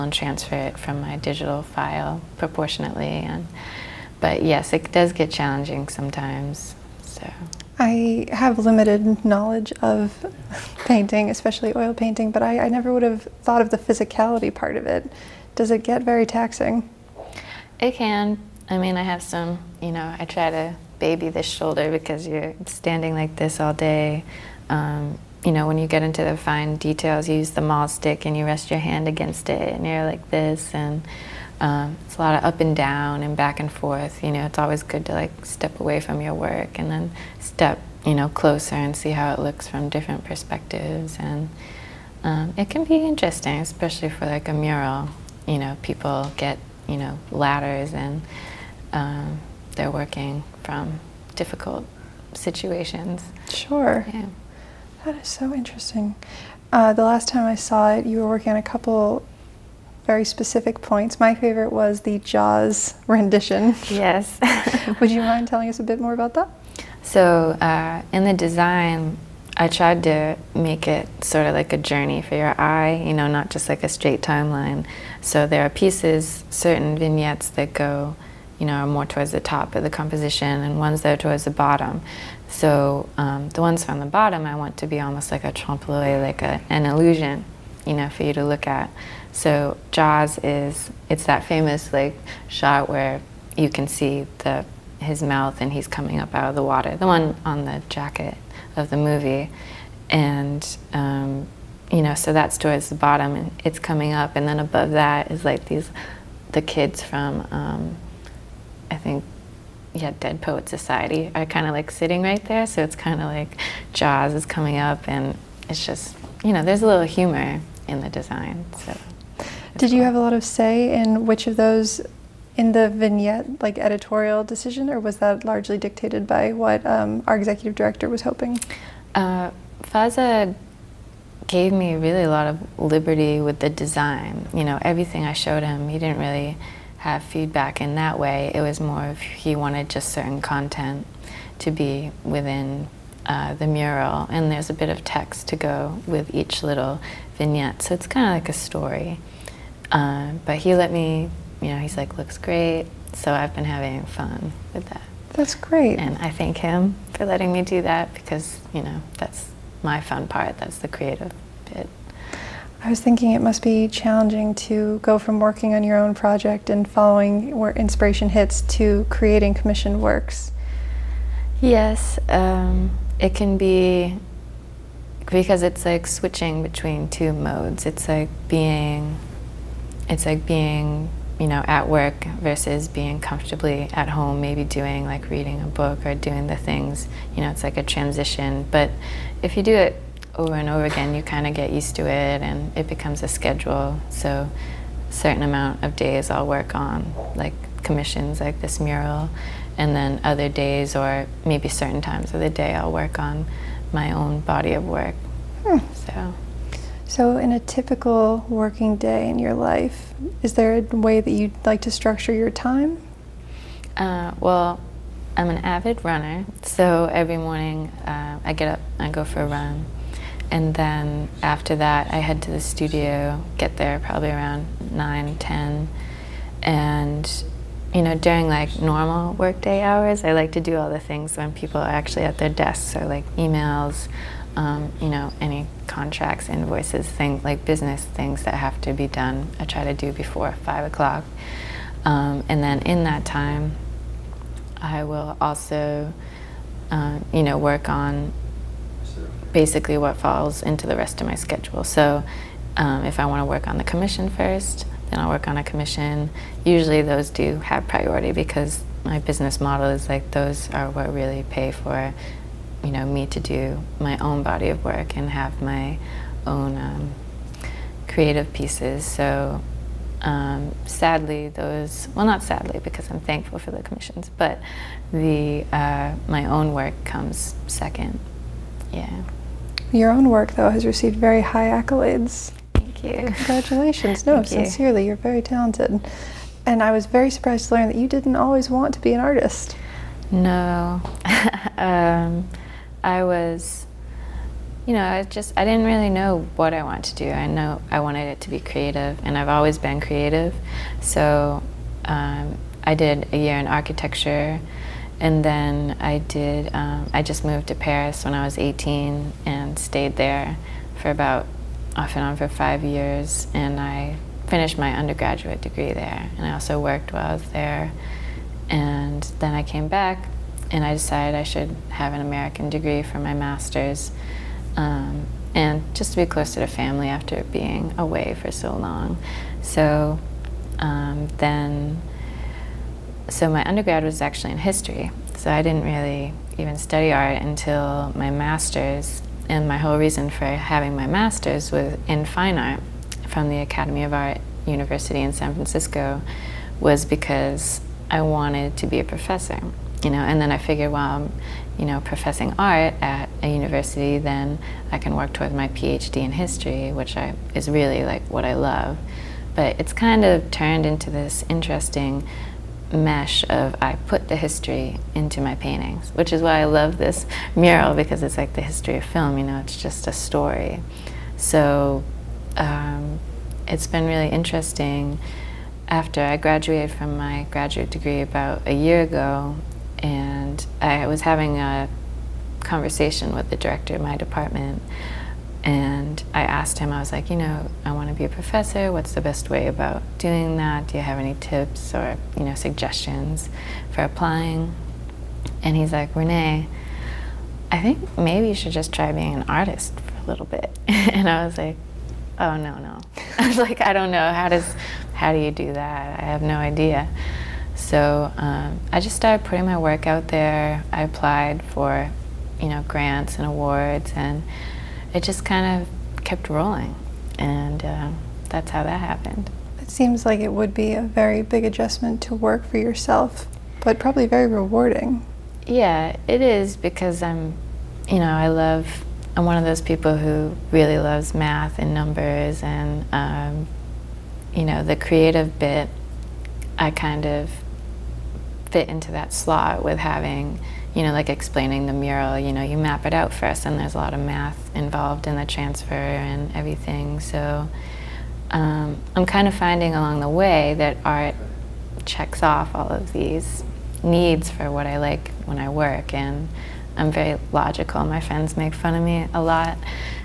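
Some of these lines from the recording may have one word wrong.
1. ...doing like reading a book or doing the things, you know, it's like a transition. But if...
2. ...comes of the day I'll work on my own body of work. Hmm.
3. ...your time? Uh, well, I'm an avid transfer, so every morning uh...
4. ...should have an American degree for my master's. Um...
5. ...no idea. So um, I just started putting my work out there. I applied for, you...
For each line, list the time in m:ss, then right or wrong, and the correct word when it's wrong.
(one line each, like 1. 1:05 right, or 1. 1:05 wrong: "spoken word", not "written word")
1. 3:04 right
2. 3:21 wrong: "times", not "comes"
3. 3:32 wrong: "runner", not "transfer"
4. 5:21 right
5. 6:46 right.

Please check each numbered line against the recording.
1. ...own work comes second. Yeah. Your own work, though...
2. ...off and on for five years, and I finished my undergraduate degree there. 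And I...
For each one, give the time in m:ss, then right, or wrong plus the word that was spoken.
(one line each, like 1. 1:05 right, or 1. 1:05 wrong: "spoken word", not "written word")
1. 4:36 right
2. 5:11 right.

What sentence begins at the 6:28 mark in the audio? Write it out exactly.
What's the best way about doing that?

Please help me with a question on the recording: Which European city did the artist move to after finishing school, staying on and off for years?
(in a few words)
Paris.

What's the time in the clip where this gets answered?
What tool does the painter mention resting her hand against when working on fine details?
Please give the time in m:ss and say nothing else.
0:27.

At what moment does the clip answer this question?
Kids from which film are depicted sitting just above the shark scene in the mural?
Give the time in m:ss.
1:50.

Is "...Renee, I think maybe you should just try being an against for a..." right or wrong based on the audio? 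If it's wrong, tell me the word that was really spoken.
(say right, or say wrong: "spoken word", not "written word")
wrong: "artist", not "against".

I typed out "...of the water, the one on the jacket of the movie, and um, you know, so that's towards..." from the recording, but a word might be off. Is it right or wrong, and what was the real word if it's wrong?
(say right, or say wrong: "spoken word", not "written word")
right.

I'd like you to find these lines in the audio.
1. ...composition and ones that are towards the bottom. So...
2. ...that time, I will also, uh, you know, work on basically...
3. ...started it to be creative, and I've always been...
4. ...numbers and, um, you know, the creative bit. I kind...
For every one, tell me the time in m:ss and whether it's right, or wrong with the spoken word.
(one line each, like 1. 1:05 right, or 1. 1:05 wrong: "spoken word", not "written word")
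1. 1:19 right
2. 4:03 right
3. 4:57 wrong: "wanted", not "started"
4. 7:11 right.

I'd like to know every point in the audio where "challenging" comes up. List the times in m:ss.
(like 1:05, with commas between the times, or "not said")
0:05, 2:43.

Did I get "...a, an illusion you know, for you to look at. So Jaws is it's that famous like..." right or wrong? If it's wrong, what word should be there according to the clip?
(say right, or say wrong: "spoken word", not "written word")
right.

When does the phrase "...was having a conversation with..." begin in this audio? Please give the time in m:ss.
6:21.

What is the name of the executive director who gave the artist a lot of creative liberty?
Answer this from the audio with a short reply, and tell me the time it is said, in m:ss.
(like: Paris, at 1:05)
Faza, at 2:09.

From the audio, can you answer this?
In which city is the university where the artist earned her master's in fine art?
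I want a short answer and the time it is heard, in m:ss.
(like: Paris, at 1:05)
San Francisco, at 5:45.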